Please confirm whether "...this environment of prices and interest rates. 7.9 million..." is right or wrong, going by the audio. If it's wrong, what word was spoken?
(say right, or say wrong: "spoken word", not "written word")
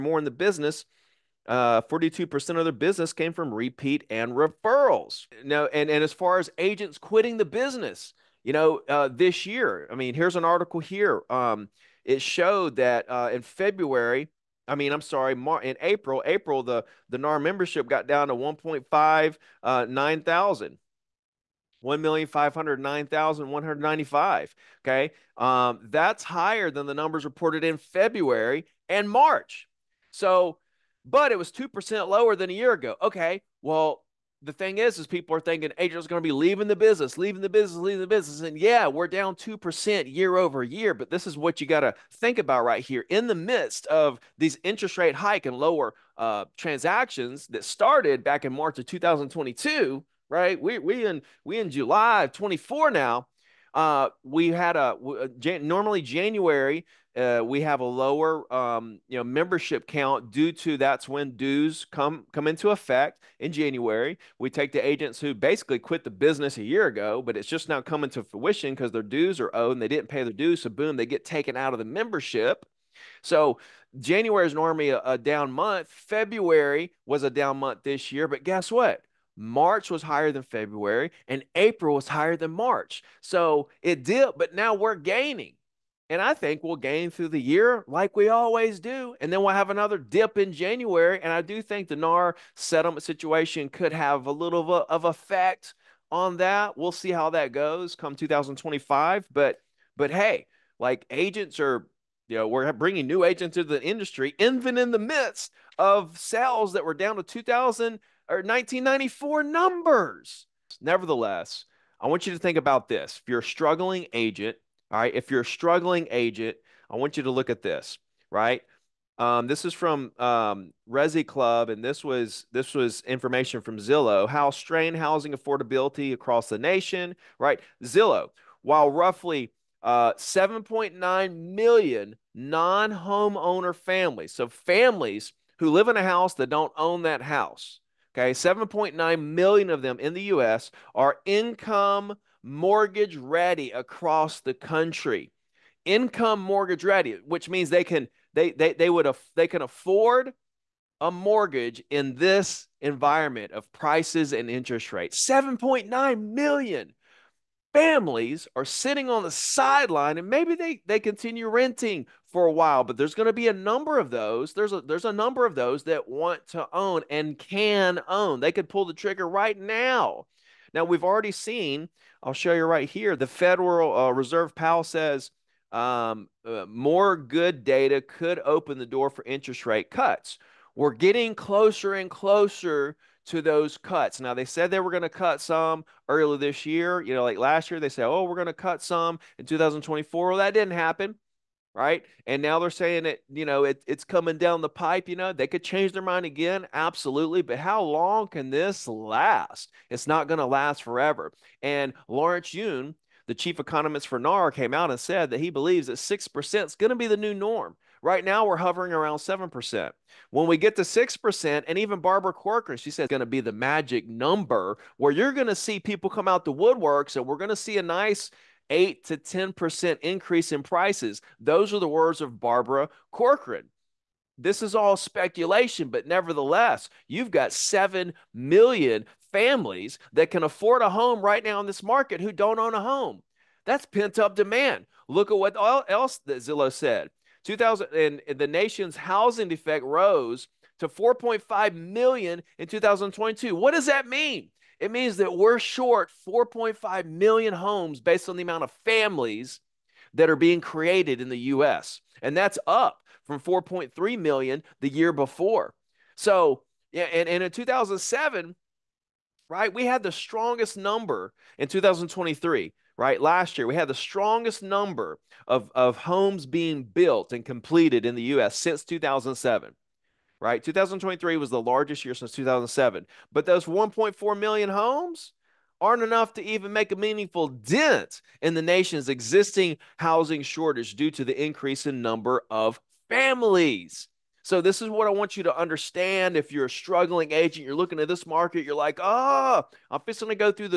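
right.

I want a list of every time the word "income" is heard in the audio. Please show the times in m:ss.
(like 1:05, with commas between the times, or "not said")
2:21, 2:25.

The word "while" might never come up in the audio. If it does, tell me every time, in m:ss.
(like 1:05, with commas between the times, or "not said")
2:08, 2:42.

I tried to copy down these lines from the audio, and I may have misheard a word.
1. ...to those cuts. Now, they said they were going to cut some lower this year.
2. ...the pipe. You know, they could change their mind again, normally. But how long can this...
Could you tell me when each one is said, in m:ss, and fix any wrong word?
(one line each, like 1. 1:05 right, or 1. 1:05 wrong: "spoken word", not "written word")
1. 3:03 wrong: "earlier", not "lower"
2. 3:14 wrong: "absolutely", not "normally".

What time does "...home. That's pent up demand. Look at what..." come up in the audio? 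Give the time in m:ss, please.
3:52.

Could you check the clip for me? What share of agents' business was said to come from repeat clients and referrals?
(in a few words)
42%.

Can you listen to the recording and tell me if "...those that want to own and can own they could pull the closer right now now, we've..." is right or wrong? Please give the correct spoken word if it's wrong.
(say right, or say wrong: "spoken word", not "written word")
wrong: "trigger", not "closer".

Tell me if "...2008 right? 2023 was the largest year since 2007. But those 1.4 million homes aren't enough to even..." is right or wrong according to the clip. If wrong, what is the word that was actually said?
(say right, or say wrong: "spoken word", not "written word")
wrong: "2007", not "2008".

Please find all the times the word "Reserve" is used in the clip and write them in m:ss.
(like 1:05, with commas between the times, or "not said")
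2:54.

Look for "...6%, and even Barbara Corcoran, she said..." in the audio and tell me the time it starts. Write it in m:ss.
3:30.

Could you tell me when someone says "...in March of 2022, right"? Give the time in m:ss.
0:48.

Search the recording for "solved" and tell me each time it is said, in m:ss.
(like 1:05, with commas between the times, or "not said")
not said.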